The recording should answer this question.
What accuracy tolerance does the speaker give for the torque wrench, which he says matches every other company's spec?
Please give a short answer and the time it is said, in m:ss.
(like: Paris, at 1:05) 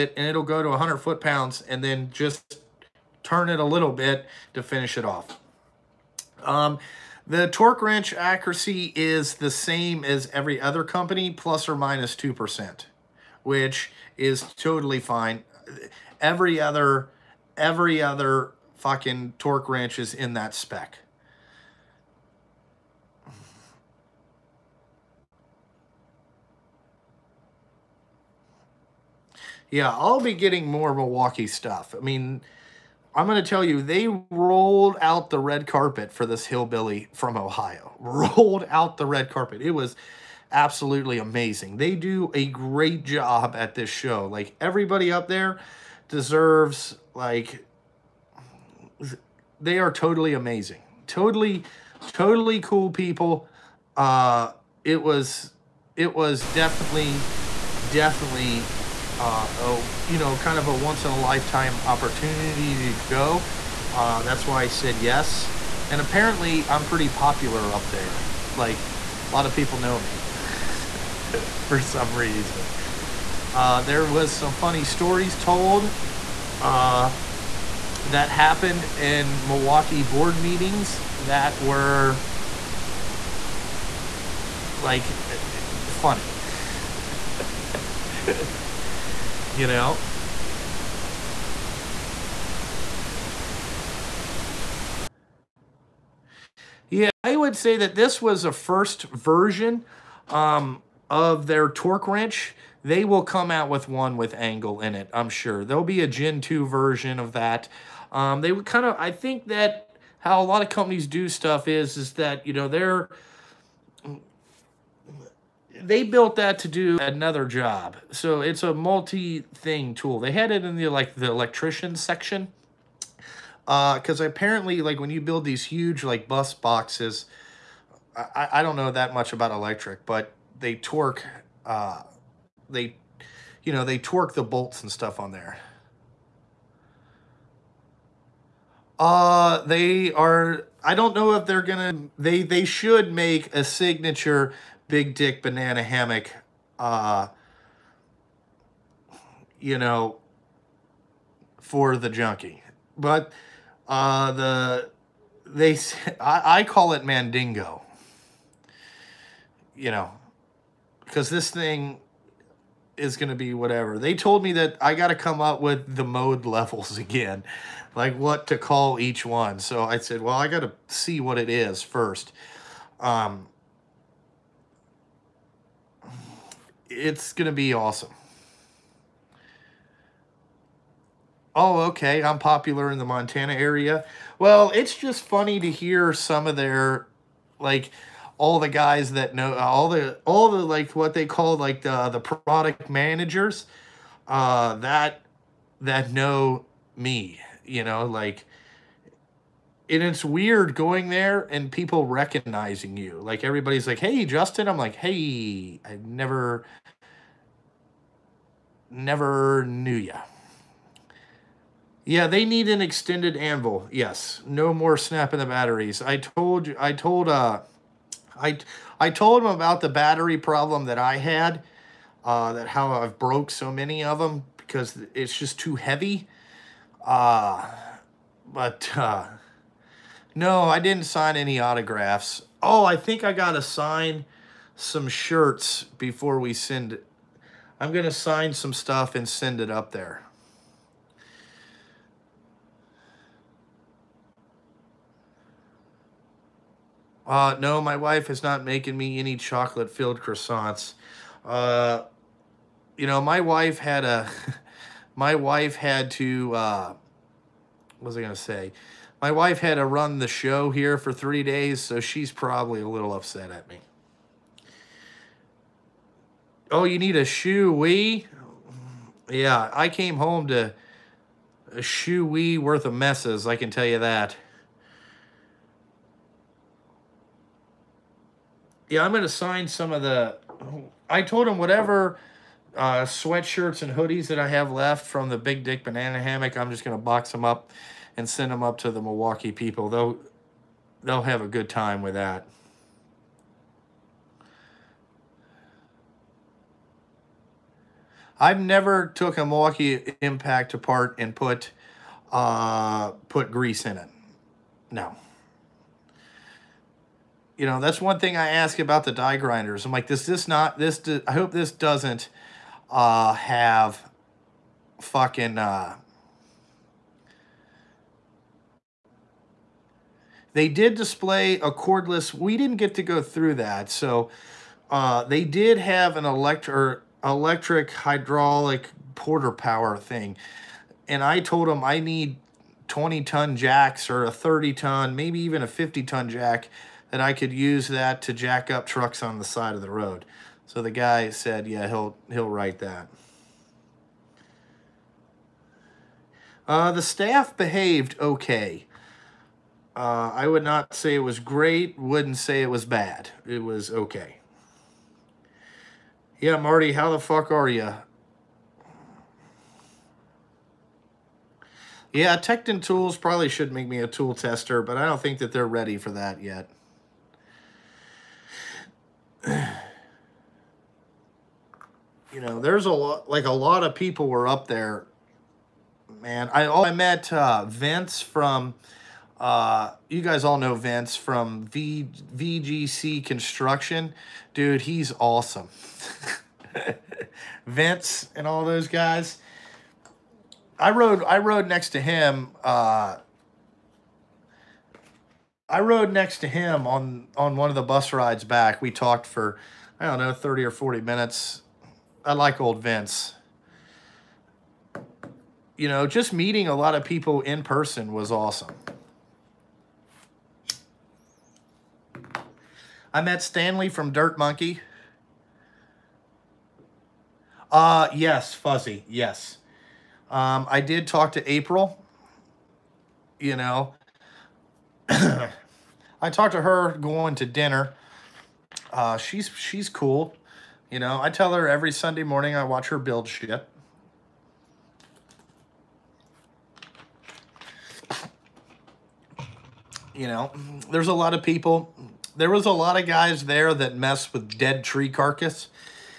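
plus or minus 2%, at 0:11.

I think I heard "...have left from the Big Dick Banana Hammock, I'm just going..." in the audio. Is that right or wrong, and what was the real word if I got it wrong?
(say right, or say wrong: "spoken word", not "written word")
right.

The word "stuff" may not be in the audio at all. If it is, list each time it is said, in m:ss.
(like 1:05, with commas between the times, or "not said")
0:31, 1:51, 2:14, 3:58.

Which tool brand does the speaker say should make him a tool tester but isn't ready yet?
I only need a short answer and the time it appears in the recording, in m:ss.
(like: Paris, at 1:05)
Tekton Tools, at 6:02.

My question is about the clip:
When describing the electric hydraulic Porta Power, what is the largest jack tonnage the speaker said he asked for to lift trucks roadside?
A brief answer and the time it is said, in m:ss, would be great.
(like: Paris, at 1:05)
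50 ton, at 5:35.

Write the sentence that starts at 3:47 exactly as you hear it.
Uh, but uh, no, I didn't sign any autographs.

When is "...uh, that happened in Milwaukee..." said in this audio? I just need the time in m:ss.
1:16.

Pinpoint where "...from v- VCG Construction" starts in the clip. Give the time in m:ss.
6:21.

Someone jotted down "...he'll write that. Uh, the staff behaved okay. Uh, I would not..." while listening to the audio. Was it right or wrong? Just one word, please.
right.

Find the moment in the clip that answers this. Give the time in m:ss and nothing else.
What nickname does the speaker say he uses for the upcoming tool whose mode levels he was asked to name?
2:37.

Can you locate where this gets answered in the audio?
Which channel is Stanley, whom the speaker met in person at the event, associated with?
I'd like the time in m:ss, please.
6:54.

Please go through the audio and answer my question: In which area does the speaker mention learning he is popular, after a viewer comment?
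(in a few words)
Montana.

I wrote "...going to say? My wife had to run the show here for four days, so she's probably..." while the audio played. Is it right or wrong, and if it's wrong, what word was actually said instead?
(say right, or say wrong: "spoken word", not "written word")
wrong: "three", not "four".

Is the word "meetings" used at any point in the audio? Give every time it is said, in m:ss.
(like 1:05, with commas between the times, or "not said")
1:20, 6:46.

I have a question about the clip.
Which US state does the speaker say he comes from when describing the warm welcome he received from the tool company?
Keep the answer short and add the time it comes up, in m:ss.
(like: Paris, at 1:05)
Ohio, at 0:37.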